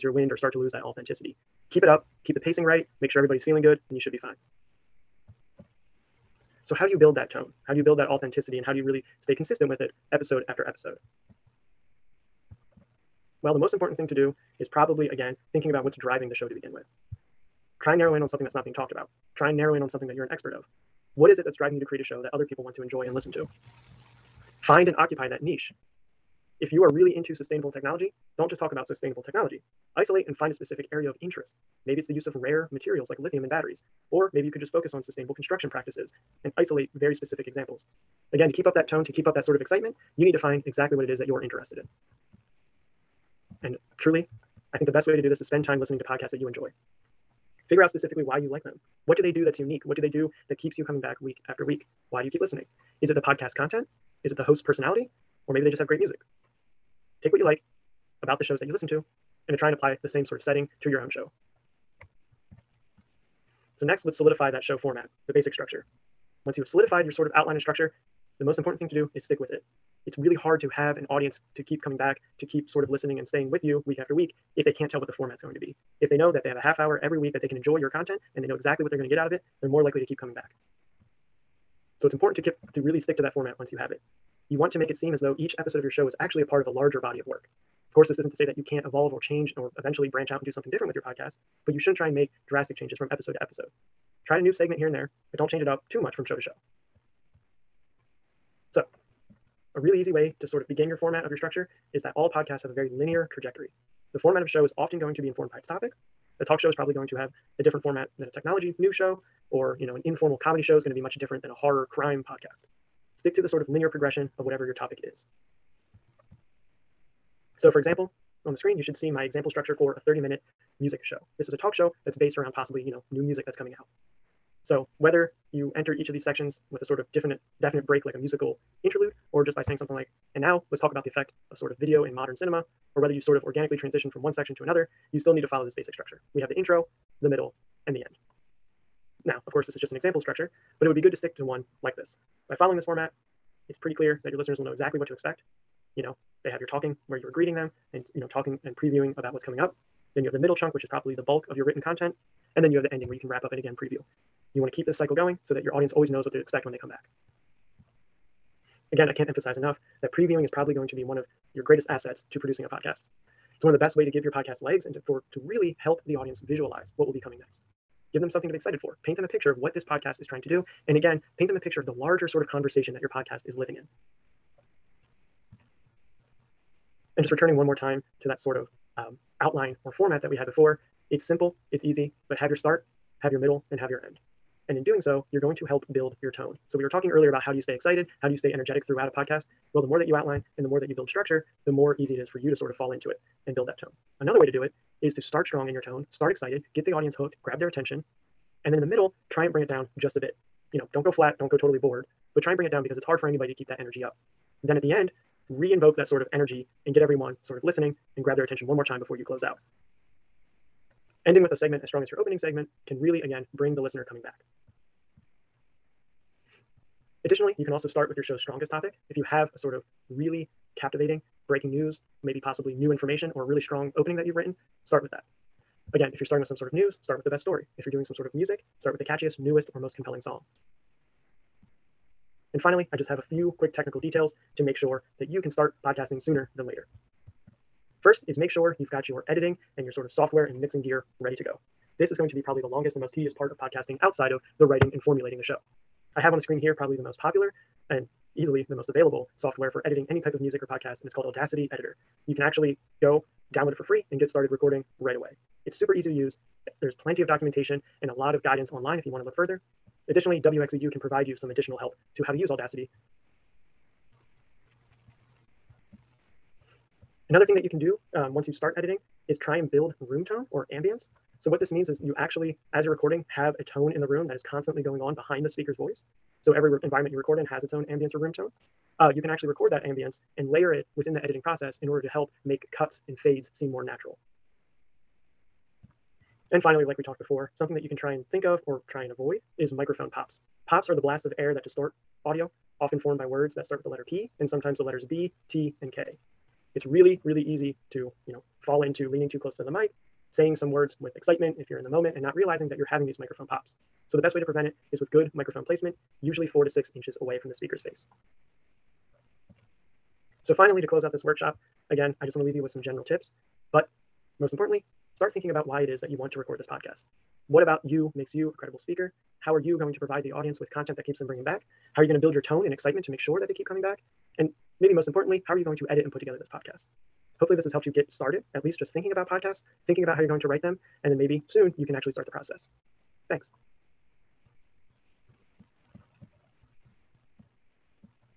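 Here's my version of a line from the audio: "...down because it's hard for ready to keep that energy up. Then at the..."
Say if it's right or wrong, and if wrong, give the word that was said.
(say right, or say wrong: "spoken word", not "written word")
wrong: "anybody", not "ready".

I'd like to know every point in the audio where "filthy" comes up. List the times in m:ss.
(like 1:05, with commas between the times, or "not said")
not said.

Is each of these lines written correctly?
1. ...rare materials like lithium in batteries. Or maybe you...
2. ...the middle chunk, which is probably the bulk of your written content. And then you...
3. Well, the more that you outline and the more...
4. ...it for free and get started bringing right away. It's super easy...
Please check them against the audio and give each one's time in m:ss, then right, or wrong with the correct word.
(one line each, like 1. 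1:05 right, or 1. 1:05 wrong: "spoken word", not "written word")
1. 0:32 right
2. 2:30 right
3. 3:09 right
4. 4:13 wrong: "recording", not "bringing".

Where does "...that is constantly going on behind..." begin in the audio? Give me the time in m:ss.
4:34.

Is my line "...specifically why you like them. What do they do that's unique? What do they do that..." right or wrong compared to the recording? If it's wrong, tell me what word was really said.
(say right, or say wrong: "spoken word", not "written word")
right.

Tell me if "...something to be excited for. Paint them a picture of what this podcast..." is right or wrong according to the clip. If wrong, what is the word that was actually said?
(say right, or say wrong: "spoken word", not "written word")
right.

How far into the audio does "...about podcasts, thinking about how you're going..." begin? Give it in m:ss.
5:29.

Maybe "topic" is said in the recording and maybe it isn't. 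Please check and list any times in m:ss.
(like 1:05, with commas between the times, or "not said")
1:45, 1:54, 3:38.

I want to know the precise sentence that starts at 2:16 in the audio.
We have the intro, the middle, and the end.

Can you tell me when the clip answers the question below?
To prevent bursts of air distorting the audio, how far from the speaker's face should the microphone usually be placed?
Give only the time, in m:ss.
5:06.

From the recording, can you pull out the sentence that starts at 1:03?
So next, let's solidify that show format, the basic structure.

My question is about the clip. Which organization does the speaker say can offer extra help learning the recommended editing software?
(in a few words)
WXVU.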